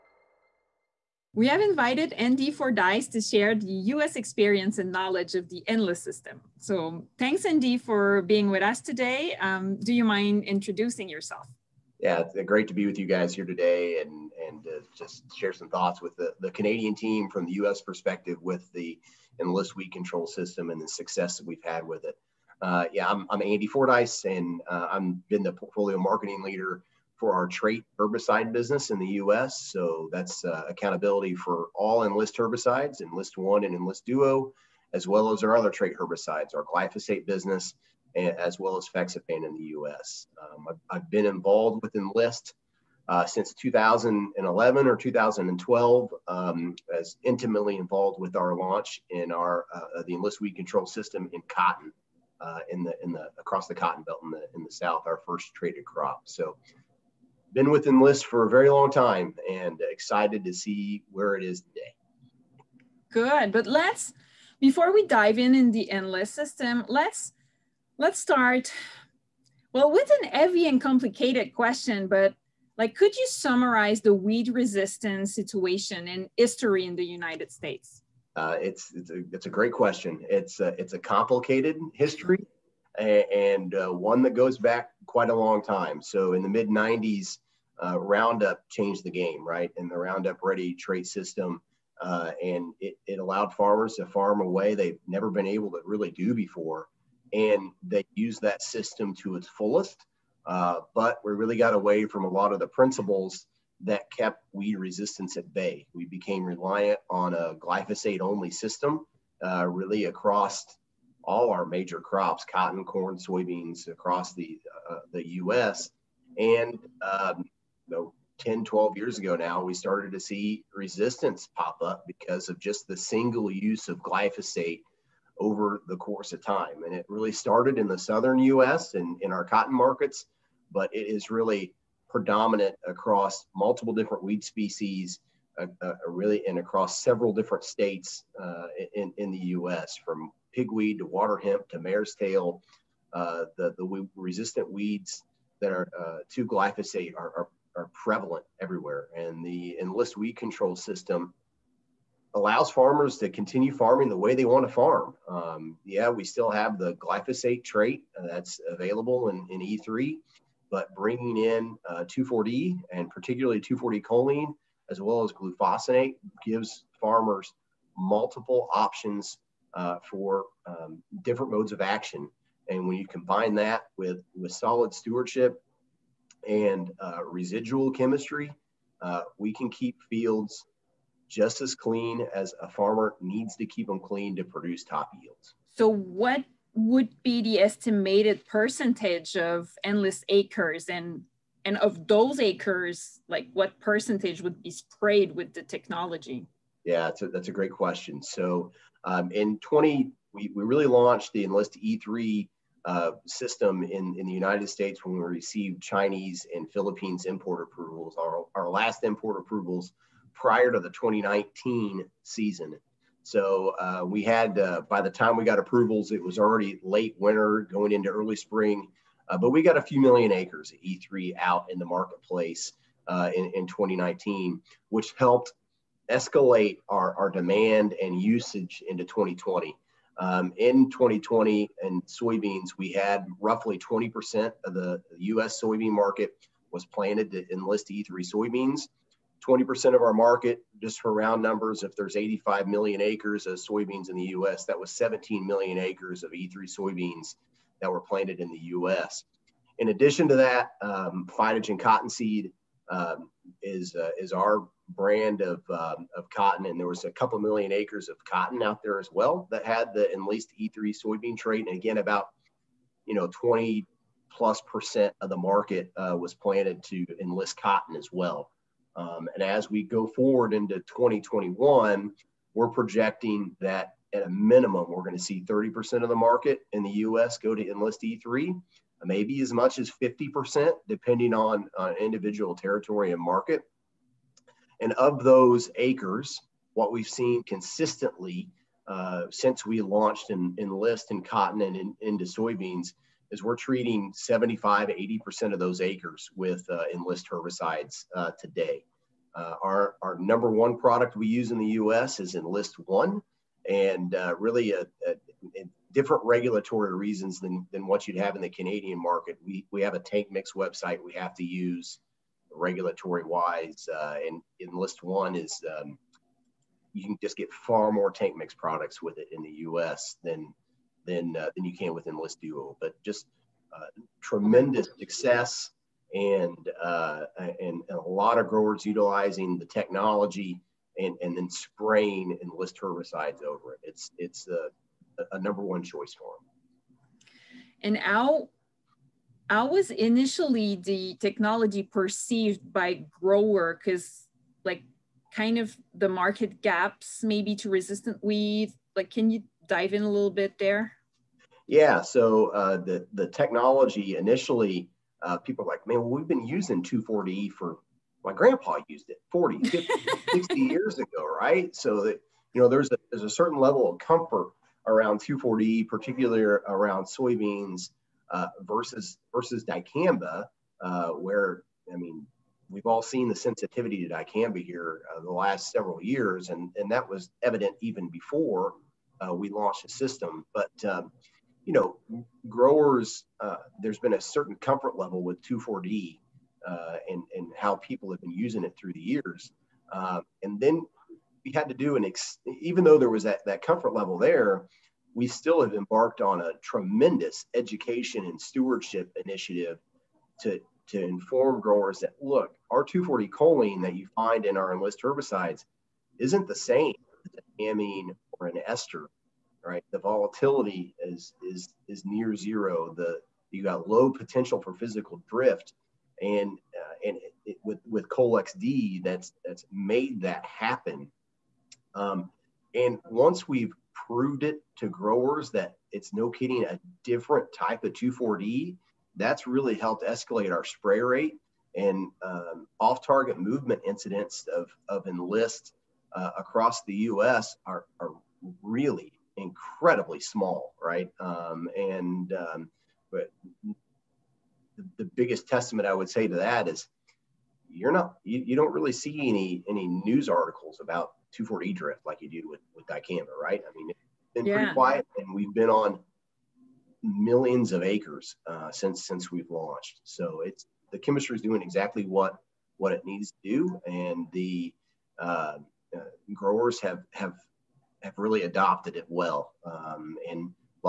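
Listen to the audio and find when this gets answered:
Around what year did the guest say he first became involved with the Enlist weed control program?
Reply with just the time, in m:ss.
0:43.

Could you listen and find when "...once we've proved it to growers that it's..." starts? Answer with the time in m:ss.
7:03.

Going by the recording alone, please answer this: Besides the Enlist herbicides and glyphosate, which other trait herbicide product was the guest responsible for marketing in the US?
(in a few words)
FeXapan.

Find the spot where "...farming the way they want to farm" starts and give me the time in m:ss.
2:33.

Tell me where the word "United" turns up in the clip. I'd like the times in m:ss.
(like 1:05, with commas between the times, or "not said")
1:17, 3:24.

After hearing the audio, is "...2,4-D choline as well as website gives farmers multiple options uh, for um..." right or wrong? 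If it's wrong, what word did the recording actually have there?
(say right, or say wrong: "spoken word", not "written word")
wrong: "glufosinate", not "website".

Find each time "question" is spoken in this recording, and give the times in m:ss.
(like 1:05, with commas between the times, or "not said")
1:11, 1:19, 3:17.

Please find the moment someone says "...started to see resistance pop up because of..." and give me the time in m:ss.
1:59.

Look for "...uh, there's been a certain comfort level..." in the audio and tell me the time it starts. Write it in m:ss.
6:23.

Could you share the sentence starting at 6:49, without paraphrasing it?
The volatility is is is near zero.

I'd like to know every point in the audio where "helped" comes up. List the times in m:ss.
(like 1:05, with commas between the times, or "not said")
3:45, 7:09.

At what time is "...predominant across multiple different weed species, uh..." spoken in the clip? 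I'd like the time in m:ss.
2:12.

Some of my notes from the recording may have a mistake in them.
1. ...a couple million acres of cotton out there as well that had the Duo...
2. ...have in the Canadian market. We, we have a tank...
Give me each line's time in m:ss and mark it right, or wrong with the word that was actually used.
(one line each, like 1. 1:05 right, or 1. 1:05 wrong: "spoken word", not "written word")
1. 4:17 wrong: "Enlist", not "Duo"
2. 5:08 right.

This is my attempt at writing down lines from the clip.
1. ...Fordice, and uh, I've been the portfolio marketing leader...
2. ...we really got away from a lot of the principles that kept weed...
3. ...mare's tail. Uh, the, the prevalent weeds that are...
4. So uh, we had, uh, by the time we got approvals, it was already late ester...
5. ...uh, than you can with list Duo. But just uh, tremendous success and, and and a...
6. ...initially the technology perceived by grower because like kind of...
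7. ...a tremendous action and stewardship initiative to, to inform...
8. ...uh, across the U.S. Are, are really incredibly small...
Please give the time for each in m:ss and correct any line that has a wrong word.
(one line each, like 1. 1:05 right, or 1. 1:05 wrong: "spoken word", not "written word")
1. 0:23 right
2. 1:41 right
3. 2:21 wrong: "resistant", not "prevalent"
4. 3:33 wrong: "winter", not "ester"
5. 5:21 right
6. 5:39 right
7. 6:36 wrong: "education", not "action"
8. 7:16 right.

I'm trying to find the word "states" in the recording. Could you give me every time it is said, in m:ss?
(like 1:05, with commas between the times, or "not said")
1:17, 2:17, 3:24.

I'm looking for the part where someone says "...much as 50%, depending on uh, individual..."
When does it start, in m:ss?
4:39.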